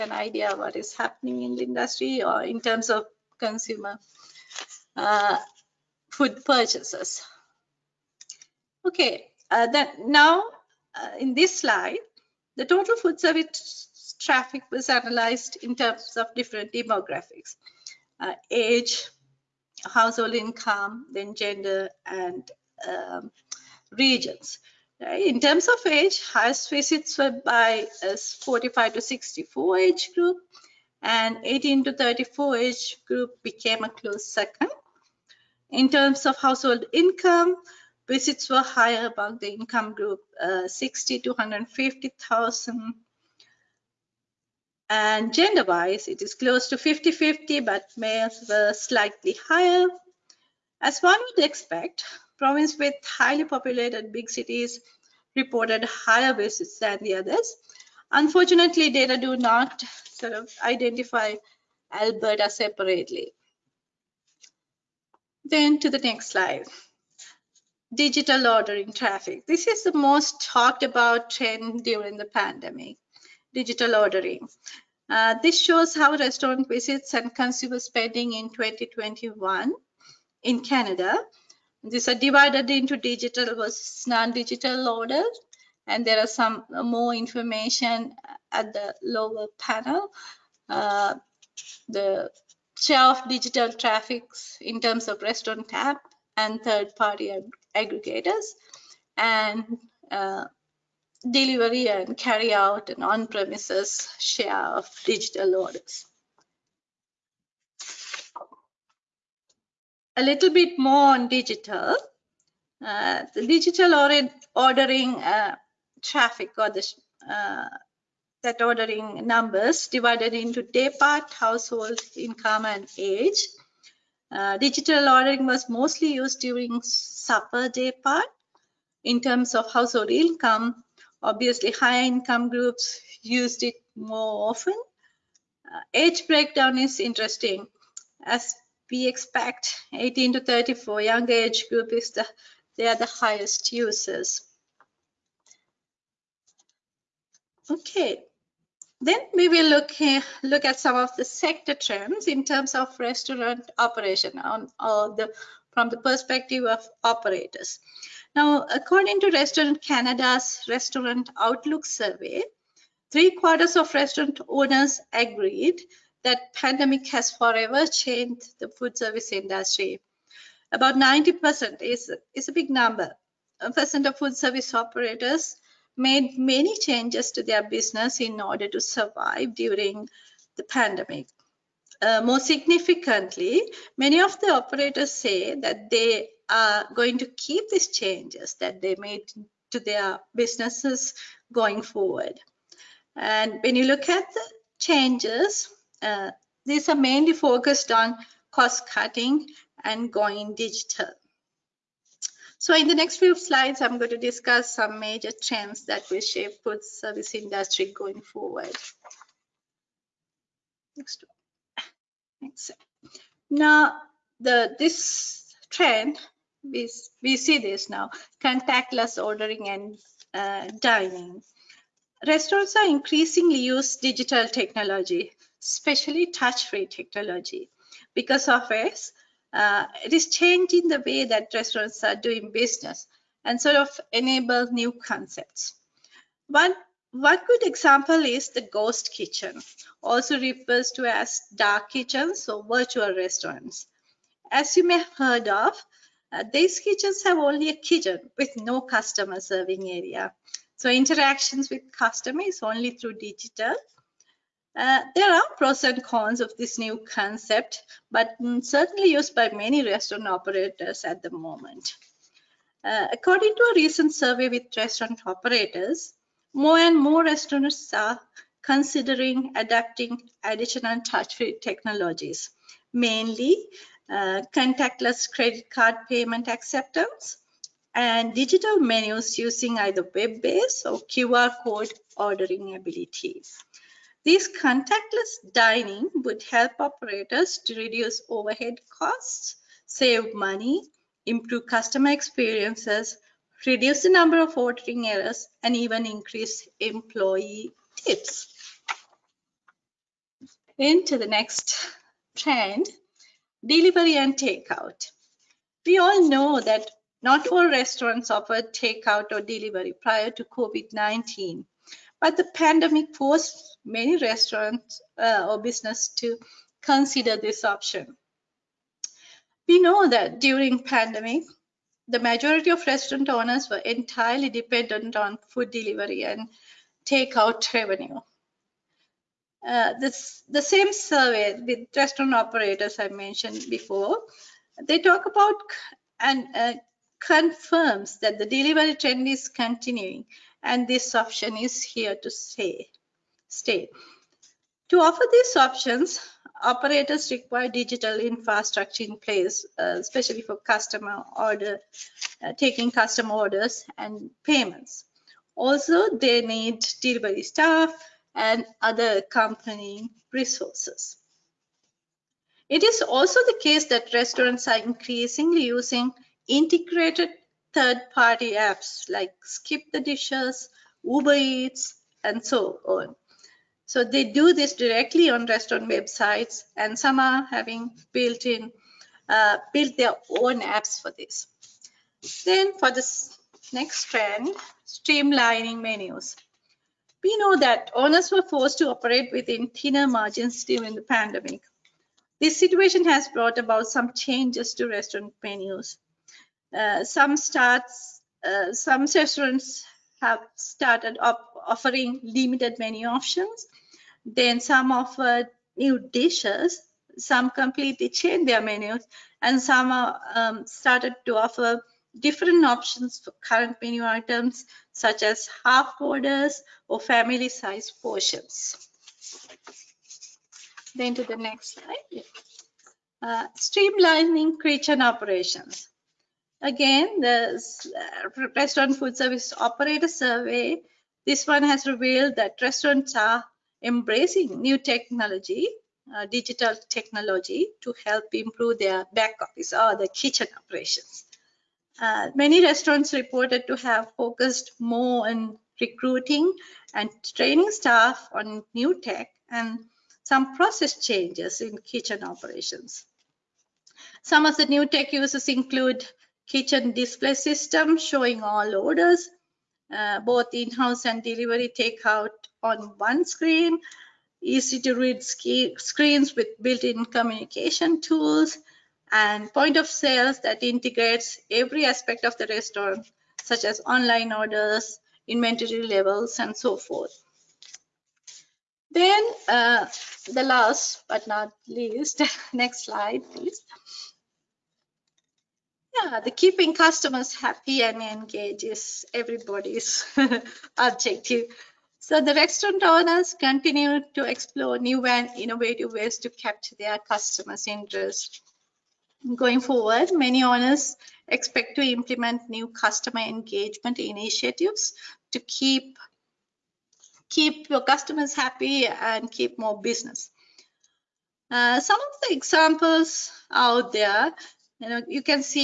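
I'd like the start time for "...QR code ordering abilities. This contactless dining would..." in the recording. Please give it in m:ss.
4:41.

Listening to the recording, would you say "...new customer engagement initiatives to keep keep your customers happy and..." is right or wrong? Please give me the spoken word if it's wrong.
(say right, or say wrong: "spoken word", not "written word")
right.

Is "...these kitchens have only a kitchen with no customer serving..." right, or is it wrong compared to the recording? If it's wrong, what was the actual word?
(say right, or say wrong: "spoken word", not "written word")
right.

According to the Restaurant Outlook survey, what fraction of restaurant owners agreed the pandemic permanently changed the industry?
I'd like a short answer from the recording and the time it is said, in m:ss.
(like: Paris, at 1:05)
Three quarters, at 2:43.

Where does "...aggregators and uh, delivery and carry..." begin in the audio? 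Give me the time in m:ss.
1:37.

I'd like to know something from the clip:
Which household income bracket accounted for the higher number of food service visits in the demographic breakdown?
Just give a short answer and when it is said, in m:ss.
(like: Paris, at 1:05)
60 to 150,000, at 0:40.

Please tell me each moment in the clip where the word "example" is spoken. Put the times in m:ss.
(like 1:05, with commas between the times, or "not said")
3:57, 8:32.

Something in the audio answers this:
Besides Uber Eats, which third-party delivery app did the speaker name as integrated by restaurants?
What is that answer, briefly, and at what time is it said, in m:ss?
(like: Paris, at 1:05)
Skip the Dishes, at 6:09.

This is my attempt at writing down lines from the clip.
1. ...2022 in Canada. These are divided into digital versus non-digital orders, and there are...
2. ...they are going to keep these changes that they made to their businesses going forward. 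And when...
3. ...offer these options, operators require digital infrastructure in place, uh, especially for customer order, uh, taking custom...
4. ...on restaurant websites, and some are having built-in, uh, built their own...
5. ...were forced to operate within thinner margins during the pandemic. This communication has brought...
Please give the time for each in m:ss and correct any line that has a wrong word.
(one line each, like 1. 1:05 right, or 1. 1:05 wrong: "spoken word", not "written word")
1. 1:18 wrong: "2021", not "2022"
2. 3:05 right
3. 5:45 right
4. 6:15 right
5. 6:28 wrong: "situation", not "communication".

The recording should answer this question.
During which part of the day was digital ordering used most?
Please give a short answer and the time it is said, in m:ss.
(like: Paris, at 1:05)
Supper, at 2:06.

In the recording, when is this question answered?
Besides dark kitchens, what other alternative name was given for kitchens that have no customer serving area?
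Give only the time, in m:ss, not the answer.
4:02.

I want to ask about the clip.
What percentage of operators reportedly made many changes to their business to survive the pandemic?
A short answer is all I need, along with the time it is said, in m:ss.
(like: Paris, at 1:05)
90%, at 2:50.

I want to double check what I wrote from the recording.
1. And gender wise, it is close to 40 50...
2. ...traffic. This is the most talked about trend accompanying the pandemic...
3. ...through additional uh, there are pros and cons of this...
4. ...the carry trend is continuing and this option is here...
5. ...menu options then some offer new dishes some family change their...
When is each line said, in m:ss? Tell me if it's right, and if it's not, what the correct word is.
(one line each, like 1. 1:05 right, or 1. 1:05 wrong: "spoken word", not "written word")
1. 0:44 wrong: "50", not "40"
2. 1:08 wrong: "during", not "accompanying"
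3. 4:12 wrong: "digital", not "additional"
4. 5:38 wrong: "delivery", not "carry"
5. 6:42 wrong: "completely", not "family".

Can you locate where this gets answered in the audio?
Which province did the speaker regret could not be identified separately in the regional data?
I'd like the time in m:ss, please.
1:01.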